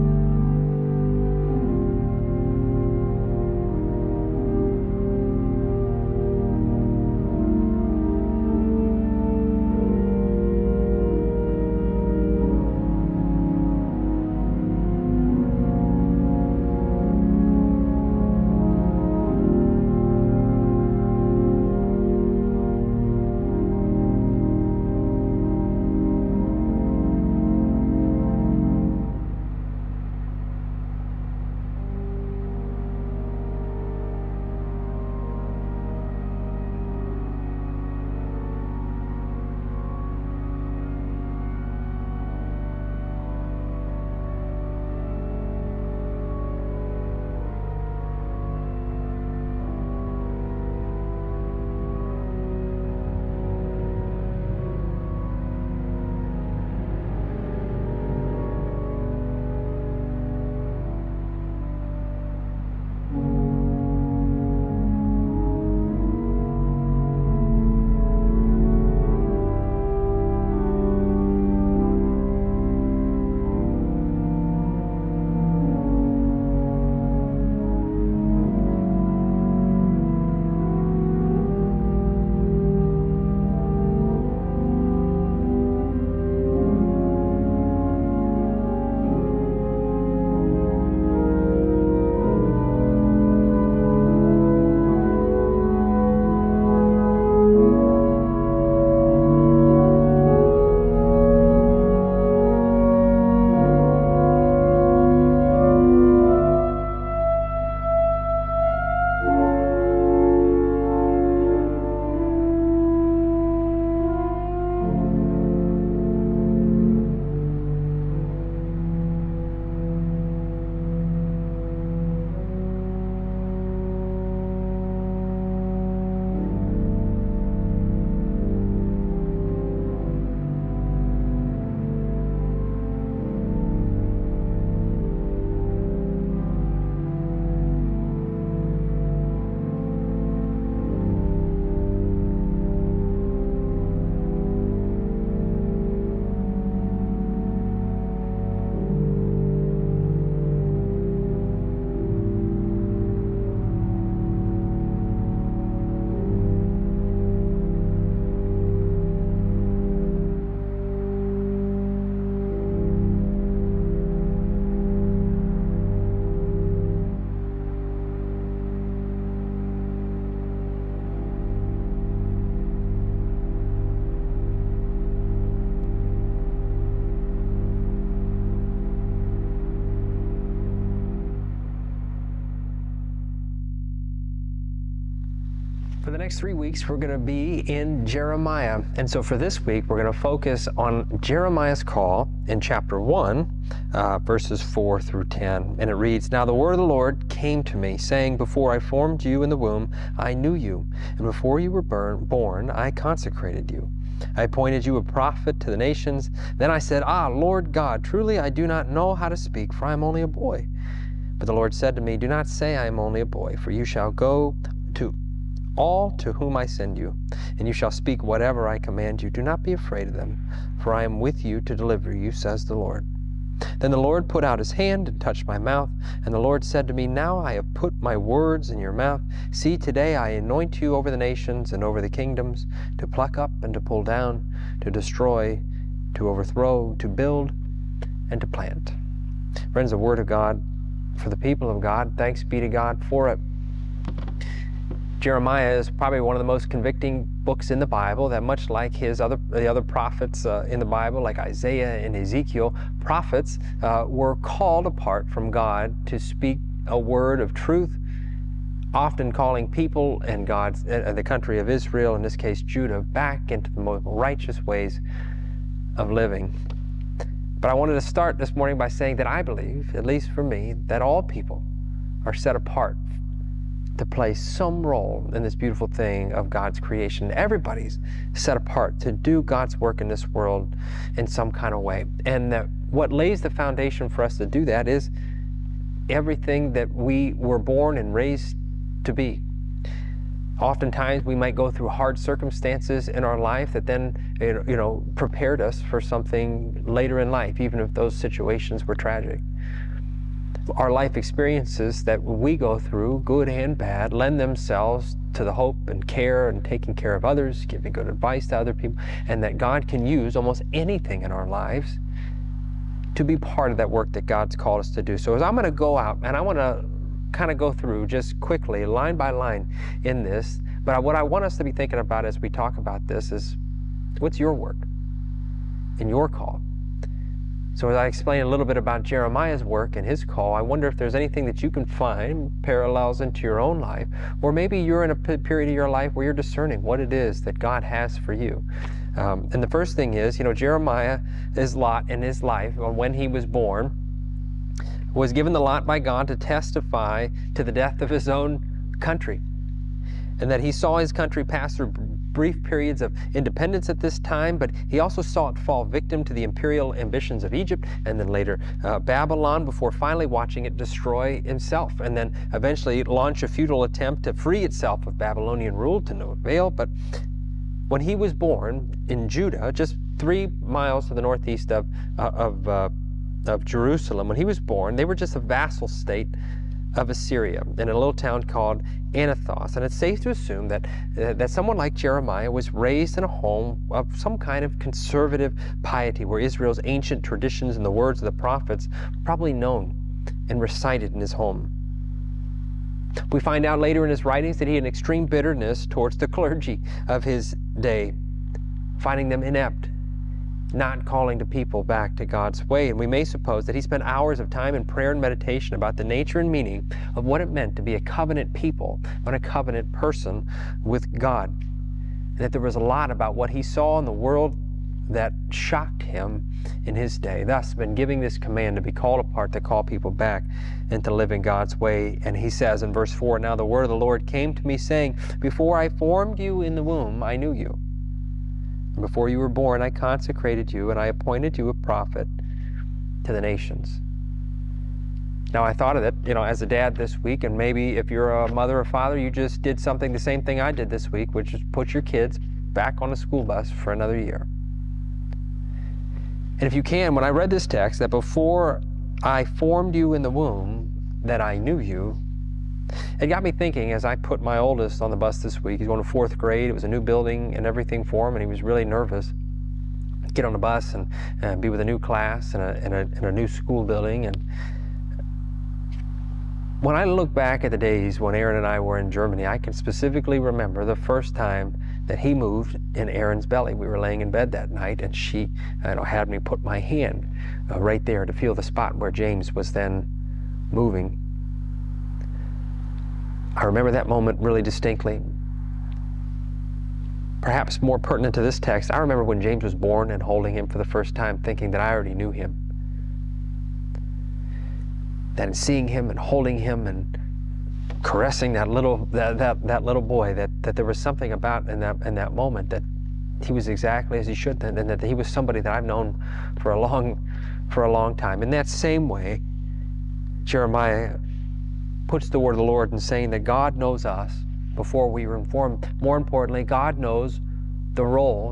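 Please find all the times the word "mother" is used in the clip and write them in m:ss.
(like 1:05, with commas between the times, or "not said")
7:18.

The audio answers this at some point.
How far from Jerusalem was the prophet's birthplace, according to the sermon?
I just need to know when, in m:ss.
6:10.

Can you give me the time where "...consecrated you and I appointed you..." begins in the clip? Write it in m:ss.
7:09.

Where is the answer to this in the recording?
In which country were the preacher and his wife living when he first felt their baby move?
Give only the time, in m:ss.
7:49.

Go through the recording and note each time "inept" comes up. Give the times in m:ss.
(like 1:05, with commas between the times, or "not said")
6:39.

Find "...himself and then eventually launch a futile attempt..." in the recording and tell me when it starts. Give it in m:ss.
6:01.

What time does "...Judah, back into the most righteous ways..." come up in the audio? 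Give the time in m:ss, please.
4:22.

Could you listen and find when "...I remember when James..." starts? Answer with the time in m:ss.
8:08.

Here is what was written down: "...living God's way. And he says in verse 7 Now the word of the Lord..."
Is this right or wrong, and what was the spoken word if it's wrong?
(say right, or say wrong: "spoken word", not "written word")
wrong: "4", not "7".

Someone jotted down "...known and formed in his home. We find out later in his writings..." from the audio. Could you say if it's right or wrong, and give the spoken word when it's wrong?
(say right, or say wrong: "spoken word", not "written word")
wrong: "recited", not "formed".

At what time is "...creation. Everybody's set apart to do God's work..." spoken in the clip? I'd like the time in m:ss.
4:36.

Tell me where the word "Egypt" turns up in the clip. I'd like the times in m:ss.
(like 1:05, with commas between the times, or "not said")
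5:57.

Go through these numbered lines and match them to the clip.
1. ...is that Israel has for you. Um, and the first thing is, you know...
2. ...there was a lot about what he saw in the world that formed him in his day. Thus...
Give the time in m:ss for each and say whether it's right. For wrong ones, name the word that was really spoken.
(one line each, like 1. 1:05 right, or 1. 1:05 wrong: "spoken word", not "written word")
1. 5:37 wrong: "God", not "Israel"
2. 6:52 wrong: "shocked", not "formed".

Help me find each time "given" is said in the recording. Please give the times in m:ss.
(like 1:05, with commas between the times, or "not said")
5:45.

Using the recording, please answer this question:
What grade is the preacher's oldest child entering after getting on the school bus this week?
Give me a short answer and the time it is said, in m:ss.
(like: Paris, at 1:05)
fourth grade, at 7:36.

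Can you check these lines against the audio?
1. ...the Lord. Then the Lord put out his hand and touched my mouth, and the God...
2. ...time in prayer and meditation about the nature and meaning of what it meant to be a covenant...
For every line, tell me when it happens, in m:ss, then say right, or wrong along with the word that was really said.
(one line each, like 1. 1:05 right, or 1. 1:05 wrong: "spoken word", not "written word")
1. 3:42 wrong: "Lord", not "God"
2. 6:44 right.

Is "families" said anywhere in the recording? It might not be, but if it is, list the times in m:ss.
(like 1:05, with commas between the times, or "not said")
not said.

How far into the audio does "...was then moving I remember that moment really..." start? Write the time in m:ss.
7:59.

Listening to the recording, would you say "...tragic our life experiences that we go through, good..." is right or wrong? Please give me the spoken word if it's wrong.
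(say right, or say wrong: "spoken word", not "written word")
right.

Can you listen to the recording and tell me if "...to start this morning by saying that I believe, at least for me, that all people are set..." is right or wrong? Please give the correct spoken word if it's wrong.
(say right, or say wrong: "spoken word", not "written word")
right.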